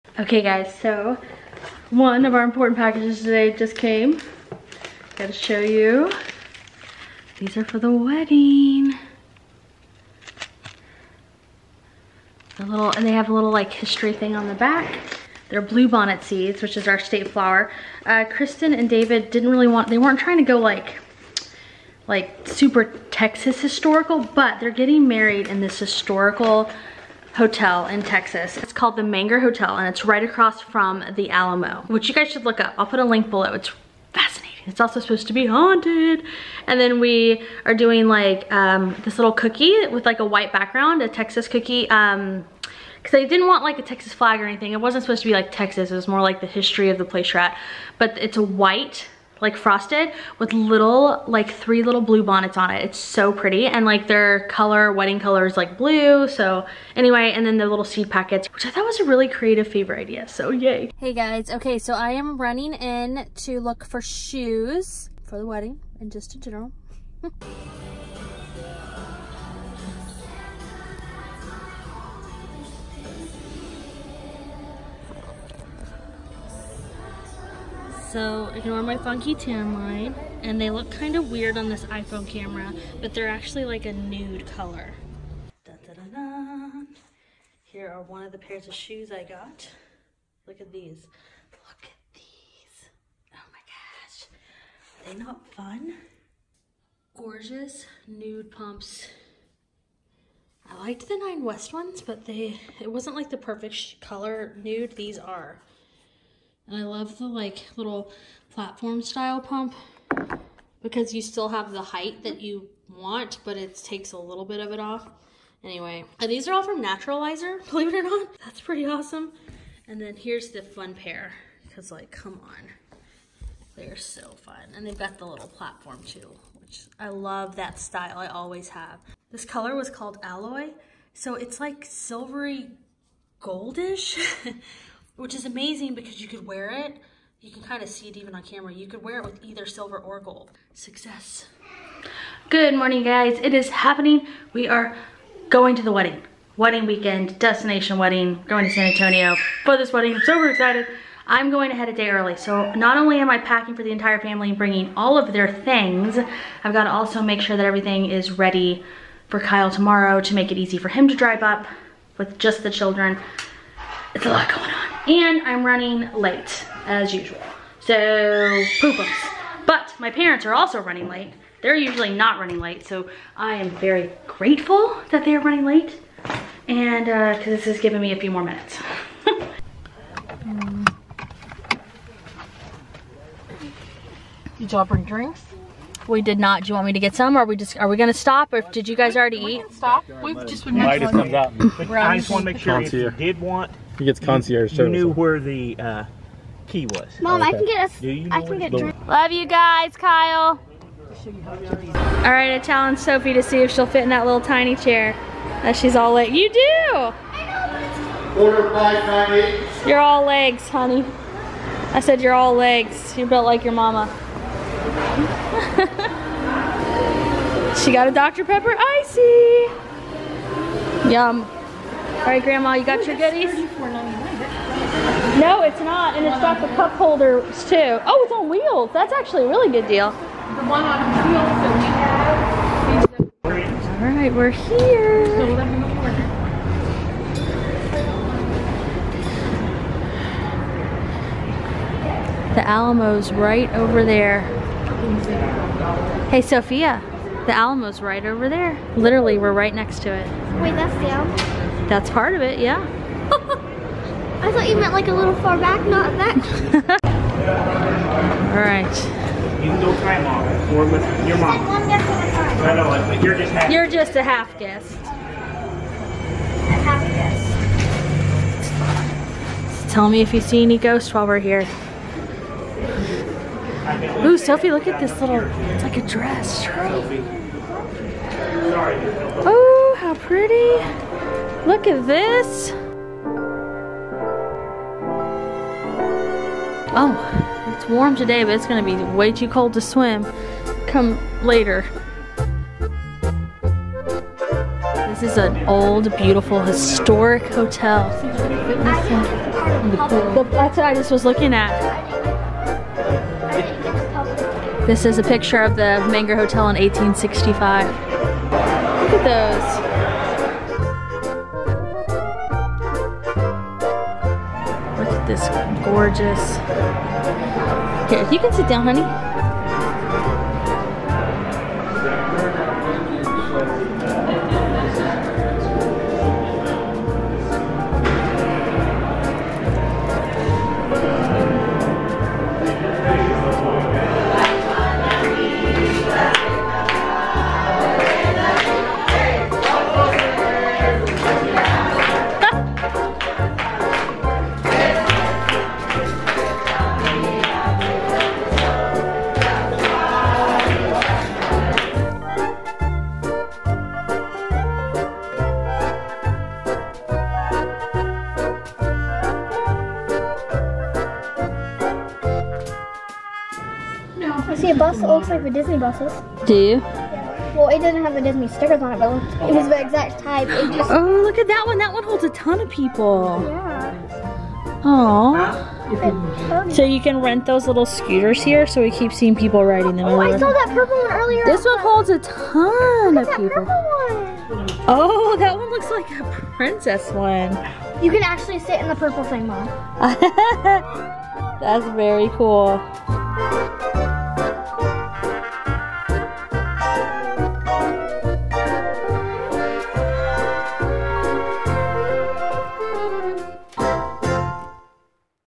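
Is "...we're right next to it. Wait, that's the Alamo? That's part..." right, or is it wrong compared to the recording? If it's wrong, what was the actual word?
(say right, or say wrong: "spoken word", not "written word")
right.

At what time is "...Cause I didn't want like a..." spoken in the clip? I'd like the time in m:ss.
0:43.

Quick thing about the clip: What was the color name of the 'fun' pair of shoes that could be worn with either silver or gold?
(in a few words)
Alloy.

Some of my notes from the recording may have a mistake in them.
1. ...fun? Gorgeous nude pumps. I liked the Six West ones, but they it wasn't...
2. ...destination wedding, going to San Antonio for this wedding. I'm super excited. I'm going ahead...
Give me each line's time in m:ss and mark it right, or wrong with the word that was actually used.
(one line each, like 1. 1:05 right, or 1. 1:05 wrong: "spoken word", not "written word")
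1. 1:35 wrong: "Nine", not "Six"
2. 2:27 right.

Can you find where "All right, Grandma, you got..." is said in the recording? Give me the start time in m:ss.
3:42.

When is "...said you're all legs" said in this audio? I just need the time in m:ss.
3:31.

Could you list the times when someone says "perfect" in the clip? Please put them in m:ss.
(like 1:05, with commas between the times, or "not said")
1:43.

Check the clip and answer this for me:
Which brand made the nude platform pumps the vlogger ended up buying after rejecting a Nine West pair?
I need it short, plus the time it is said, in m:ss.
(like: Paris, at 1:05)
Naturalizer, at 1:56.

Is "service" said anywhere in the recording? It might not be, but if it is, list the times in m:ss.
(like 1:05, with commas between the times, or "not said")
3:14.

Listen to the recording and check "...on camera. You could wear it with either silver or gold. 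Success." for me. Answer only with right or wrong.
right.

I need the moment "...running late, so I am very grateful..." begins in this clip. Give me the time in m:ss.
2:52.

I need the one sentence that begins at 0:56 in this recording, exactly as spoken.
So anyway, and then the little seed packets, which I thought was a really creative favor idea.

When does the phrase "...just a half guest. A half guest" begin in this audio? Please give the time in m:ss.
4:23.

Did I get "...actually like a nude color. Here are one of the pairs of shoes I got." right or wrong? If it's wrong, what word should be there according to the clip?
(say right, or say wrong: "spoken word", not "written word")
right.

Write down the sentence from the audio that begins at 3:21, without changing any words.
All right, I challenge Sophie to see if she'll fit in that little tiny chair that she's all leg.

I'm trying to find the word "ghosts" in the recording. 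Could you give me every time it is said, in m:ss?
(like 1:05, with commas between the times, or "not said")
4:30.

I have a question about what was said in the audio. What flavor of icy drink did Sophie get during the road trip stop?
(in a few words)
Dr. Pepper.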